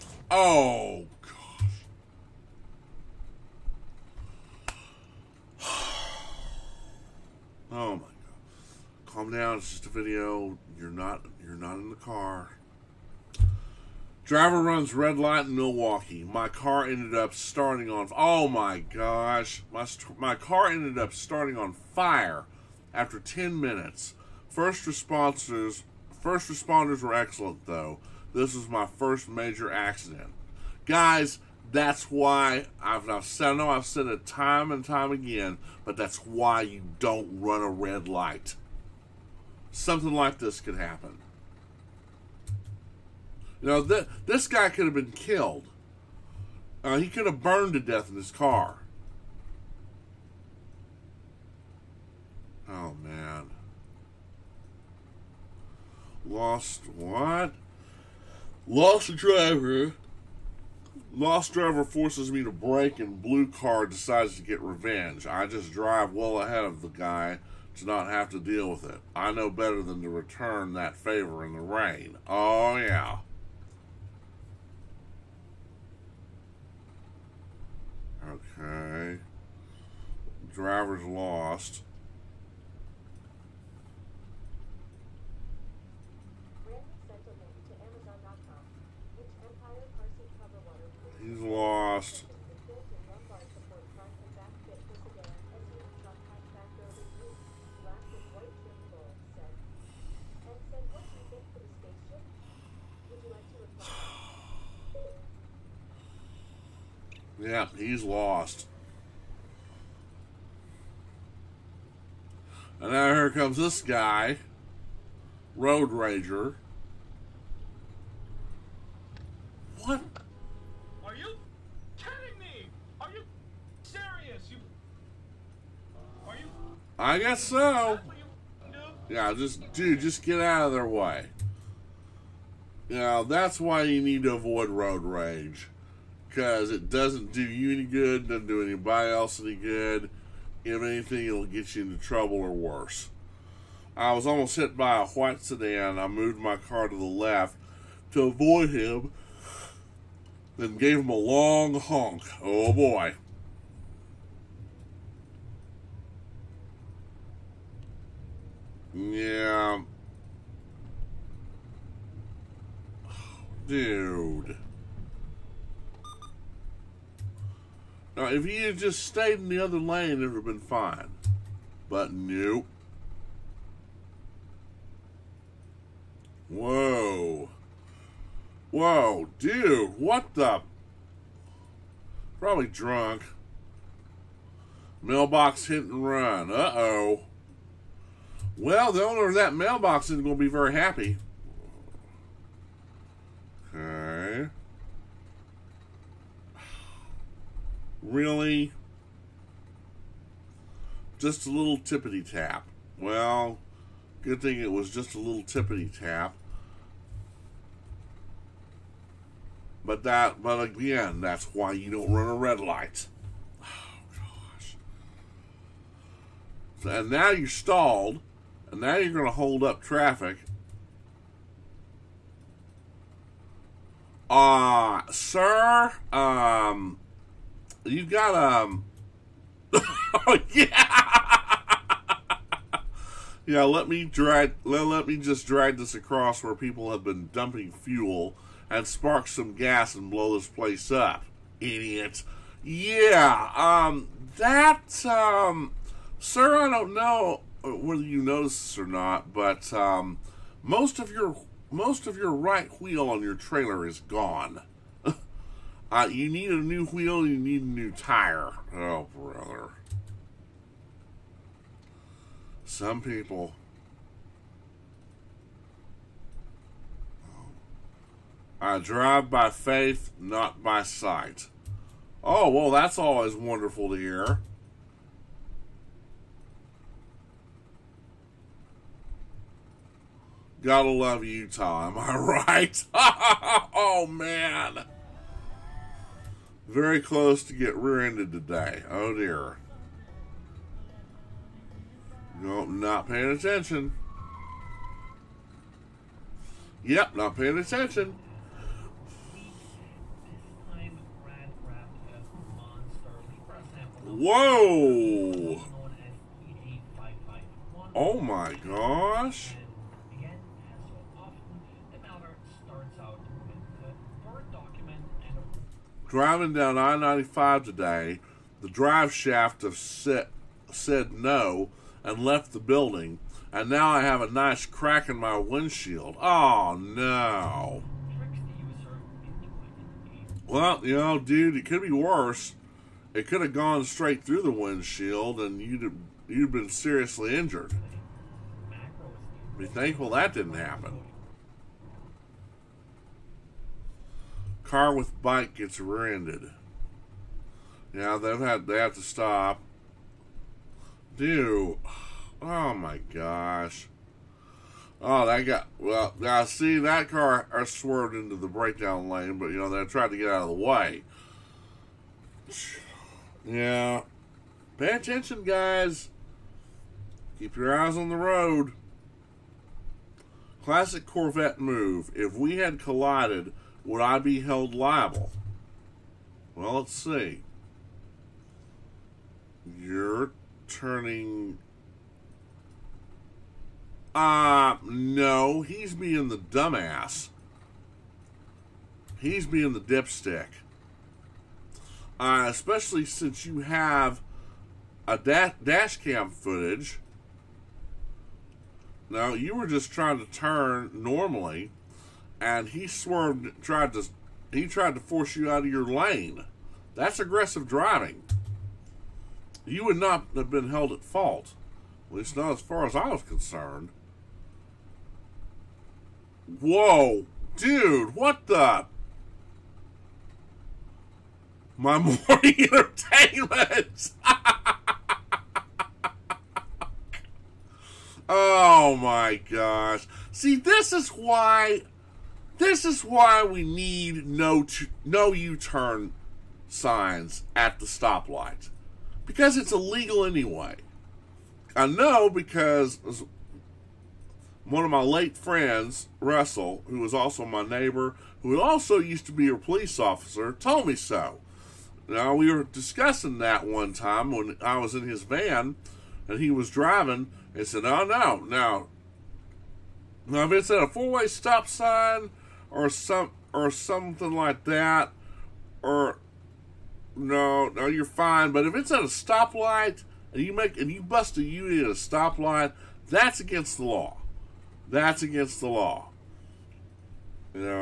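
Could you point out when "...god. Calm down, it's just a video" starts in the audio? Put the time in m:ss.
0:08.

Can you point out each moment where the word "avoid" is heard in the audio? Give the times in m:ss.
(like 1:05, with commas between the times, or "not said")
2:14, 2:28.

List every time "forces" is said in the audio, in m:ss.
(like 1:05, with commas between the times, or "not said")
1:01, 6:45.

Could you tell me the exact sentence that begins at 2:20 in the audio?
If anything, it'll get you into trouble or worse.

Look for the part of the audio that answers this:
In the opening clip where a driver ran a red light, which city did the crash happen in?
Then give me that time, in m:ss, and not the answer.
0:15.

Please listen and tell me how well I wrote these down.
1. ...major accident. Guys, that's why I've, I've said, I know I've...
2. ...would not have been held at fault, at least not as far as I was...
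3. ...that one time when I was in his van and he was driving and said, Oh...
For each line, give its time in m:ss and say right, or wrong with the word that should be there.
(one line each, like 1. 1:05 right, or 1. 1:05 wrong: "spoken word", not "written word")
1. 0:29 right
2. 6:49 right
3. 7:33 right.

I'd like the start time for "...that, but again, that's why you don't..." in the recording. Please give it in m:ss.
3:30.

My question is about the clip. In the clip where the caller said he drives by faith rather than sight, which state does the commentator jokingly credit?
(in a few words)
Utah.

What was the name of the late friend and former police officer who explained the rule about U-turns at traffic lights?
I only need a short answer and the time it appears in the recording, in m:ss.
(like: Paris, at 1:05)
Russell, at 7:26.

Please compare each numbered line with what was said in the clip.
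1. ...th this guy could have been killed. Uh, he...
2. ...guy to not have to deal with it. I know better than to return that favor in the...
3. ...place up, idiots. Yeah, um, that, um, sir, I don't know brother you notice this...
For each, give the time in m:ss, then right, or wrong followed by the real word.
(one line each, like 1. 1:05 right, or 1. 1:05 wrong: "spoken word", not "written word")
1. 0:43 right
2. 1:06 right
3. 4:00 wrong: "whether", not "brother".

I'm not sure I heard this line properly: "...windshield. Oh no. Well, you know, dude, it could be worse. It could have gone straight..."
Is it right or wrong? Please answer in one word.
right.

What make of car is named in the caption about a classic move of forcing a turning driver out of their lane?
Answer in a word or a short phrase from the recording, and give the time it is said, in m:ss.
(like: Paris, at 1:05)
Corvette, at 6:11.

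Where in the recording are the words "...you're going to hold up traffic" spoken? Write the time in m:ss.
3:38.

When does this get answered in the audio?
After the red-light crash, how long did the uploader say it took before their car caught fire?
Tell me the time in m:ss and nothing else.
0:23.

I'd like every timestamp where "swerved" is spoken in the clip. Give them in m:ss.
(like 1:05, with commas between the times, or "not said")
5:57, 6:42.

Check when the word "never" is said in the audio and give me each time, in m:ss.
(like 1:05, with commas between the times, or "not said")
not said.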